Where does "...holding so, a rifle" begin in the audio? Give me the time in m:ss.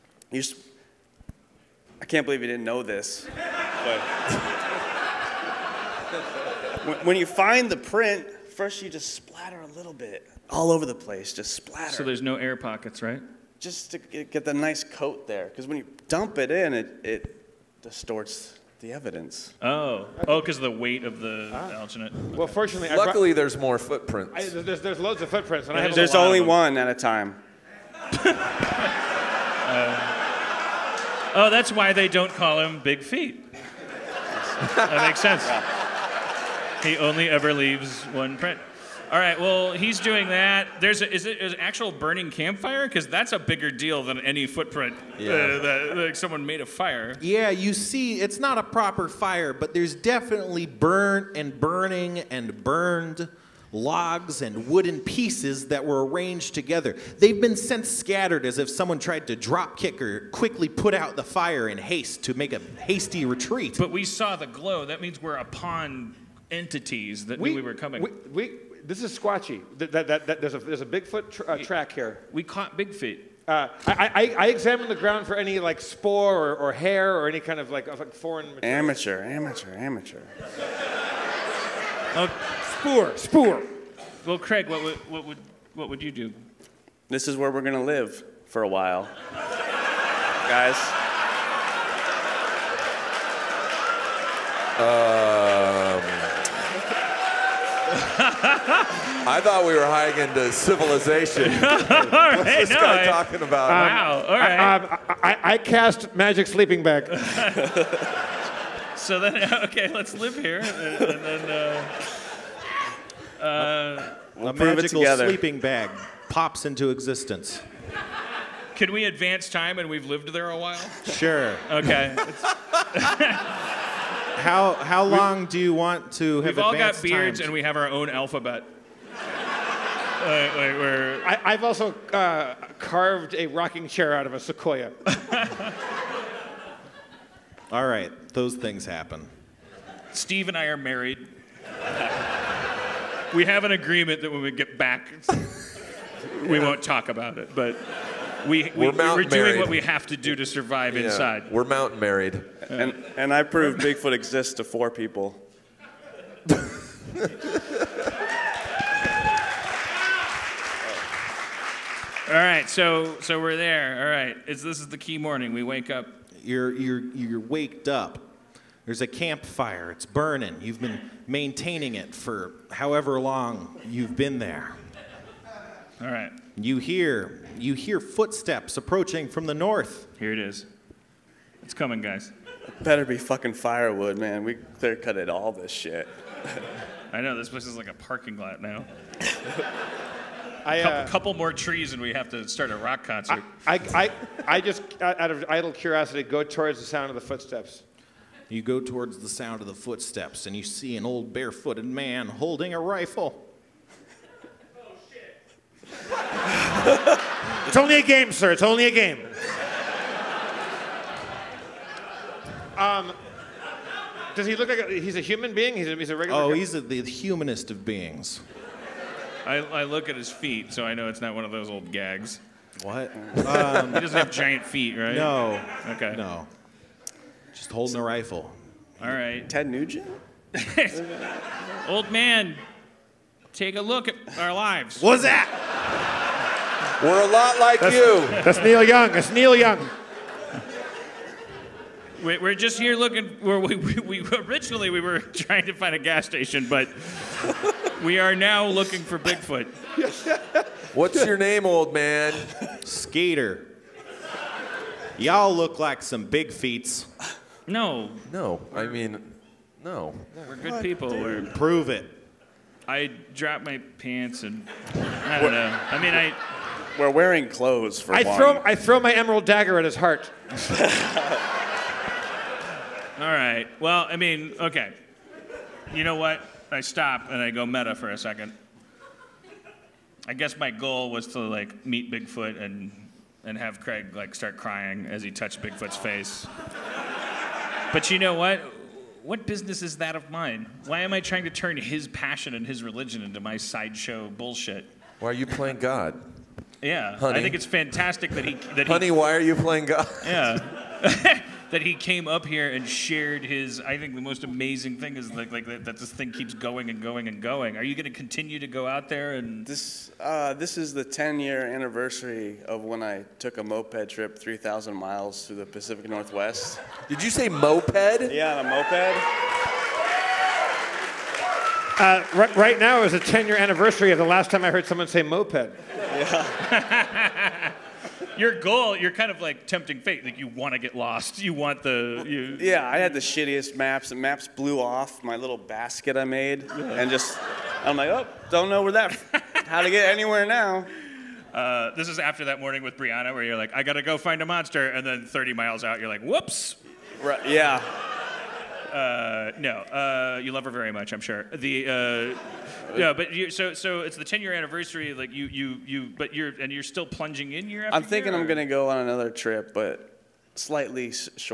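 3:47.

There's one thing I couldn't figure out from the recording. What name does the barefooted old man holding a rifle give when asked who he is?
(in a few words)
Skeeter.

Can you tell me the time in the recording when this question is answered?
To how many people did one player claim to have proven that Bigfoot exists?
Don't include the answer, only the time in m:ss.
2:34.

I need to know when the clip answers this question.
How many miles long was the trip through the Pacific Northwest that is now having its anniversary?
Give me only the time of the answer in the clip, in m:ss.
5:14.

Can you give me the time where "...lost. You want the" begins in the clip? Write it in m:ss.
5:30.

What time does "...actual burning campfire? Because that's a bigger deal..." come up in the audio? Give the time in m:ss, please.
0:41.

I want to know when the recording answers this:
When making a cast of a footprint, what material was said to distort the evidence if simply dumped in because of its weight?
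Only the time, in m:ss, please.
0:21.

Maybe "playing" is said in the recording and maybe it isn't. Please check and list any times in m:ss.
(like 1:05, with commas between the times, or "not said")
4:55, 4:59.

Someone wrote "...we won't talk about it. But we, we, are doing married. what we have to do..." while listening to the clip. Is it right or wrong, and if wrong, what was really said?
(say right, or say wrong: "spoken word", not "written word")
right.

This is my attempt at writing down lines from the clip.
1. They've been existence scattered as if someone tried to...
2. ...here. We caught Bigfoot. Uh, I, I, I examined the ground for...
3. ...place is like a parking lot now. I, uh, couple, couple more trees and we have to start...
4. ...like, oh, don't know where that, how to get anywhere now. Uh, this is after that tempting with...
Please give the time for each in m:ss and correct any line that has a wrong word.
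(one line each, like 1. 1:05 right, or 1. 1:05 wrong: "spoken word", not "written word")
1. 0:57 wrong: "since", not "existence"
2. 1:11 right
3. 3:07 right
4. 5:37 wrong: "morning", not "tempting".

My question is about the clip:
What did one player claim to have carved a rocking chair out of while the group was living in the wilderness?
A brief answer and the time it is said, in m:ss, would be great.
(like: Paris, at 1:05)
A sequoia, at 2:14.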